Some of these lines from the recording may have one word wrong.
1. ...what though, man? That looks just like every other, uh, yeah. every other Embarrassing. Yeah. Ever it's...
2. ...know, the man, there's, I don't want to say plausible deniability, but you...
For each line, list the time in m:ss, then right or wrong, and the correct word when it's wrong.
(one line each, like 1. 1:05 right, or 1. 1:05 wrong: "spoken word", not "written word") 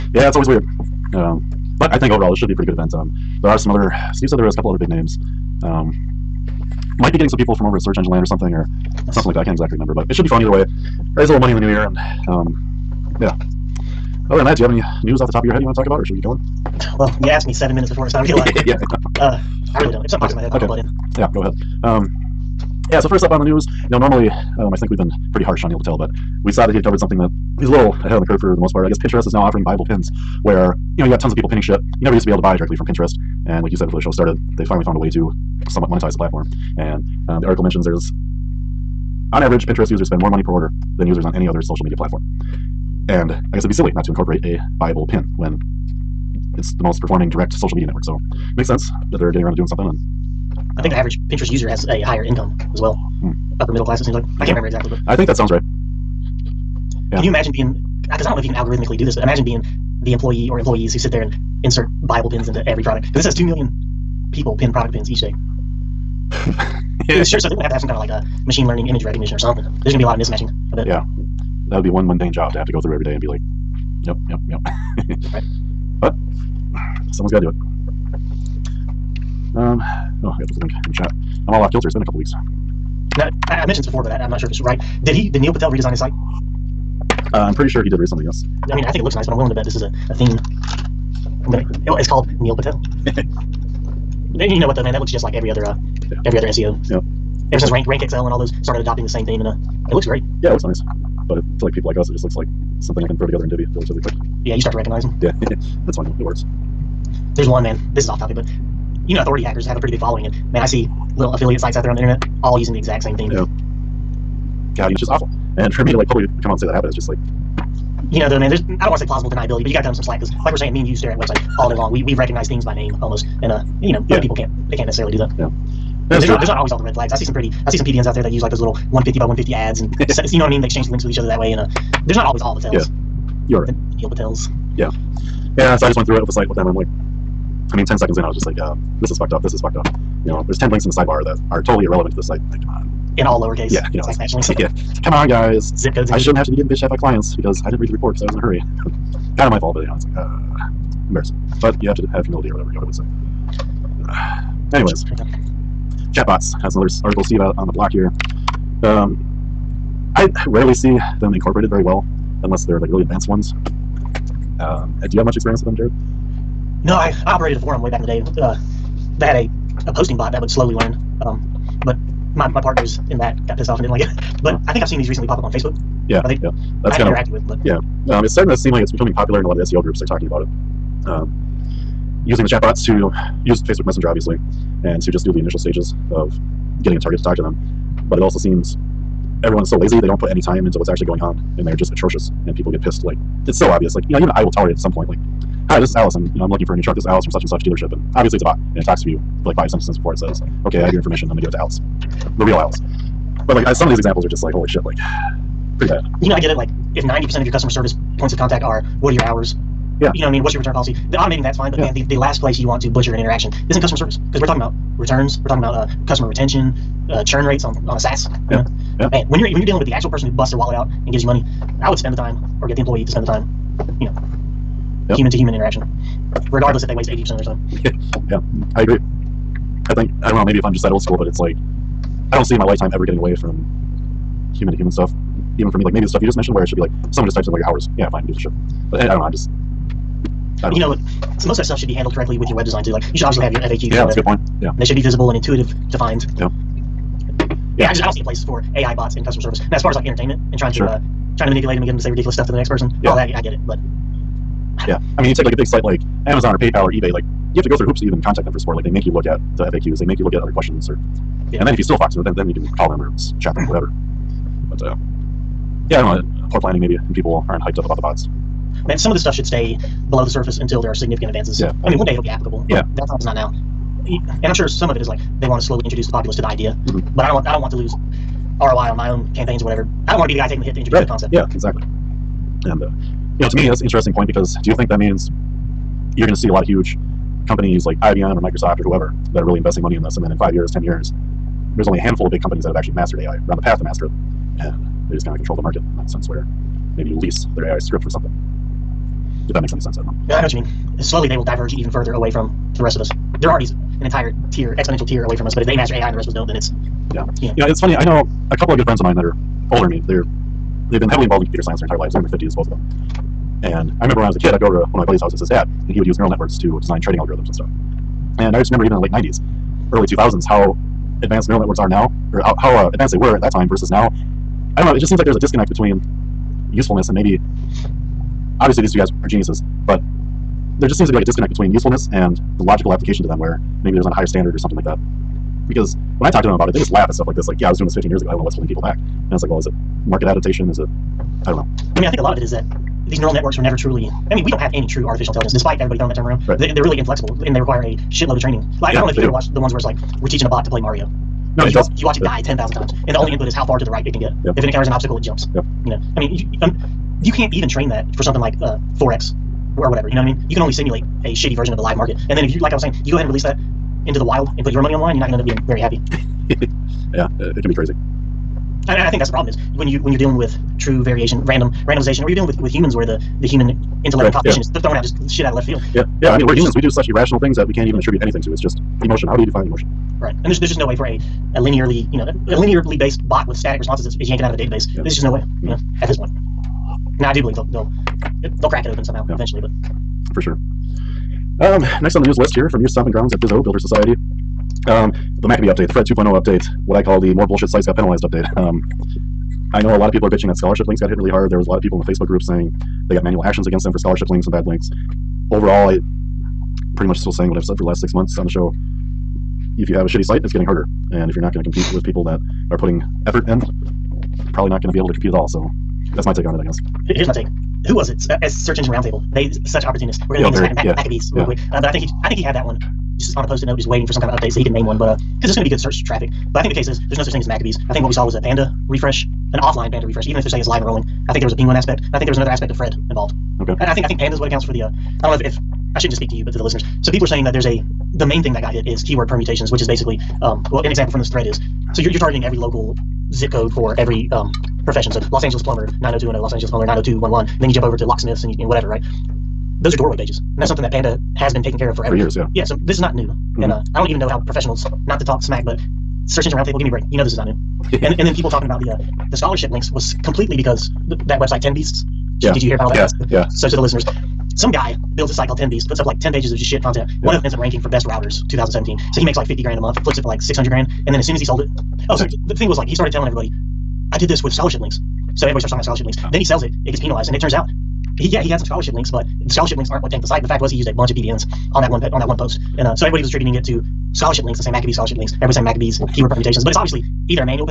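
1. 1:34 wrong: "SEO", not "Embarrassing"
2. 1:58 right.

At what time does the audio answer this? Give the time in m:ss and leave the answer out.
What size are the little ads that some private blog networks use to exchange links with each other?
2:08.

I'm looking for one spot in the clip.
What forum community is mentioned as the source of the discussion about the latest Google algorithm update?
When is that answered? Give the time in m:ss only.
6:33.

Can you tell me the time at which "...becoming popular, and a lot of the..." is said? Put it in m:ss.
2:58.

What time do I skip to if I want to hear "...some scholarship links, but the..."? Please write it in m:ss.
7:58.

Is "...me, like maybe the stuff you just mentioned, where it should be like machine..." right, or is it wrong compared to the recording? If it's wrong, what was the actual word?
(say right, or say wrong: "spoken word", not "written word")
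wrong: "someone", not "machine".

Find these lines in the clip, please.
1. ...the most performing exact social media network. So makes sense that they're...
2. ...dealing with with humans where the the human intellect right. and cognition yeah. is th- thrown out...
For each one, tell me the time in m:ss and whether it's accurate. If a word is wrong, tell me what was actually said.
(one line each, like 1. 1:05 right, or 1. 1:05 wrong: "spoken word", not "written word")
1. 0:46 wrong: "direct", not "exact"
2. 6:12 right.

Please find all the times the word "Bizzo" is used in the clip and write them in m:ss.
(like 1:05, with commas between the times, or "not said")
6:33.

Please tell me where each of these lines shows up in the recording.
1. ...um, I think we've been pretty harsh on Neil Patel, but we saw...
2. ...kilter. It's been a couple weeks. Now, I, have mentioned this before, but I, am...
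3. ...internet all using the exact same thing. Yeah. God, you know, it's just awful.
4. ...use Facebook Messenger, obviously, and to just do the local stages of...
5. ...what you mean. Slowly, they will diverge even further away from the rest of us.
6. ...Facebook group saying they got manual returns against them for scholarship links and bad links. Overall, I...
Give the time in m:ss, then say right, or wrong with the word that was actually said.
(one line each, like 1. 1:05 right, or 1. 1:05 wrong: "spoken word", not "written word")
1. 0:24 right
2. 1:21 right
3. 1:51 right
4. 3:03 wrong: "initial", not "local"
5. 5:00 right
6. 6:42 wrong: "actions", not "returns".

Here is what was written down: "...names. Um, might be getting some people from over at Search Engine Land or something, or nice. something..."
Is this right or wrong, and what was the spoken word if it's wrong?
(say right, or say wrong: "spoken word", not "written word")
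right.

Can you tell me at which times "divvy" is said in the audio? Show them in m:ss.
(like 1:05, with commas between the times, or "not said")
1:43.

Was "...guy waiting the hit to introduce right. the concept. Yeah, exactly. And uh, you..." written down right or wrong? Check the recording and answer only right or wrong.
wrong.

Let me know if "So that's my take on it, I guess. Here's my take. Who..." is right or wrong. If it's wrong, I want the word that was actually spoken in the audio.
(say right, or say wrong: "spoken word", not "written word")
right.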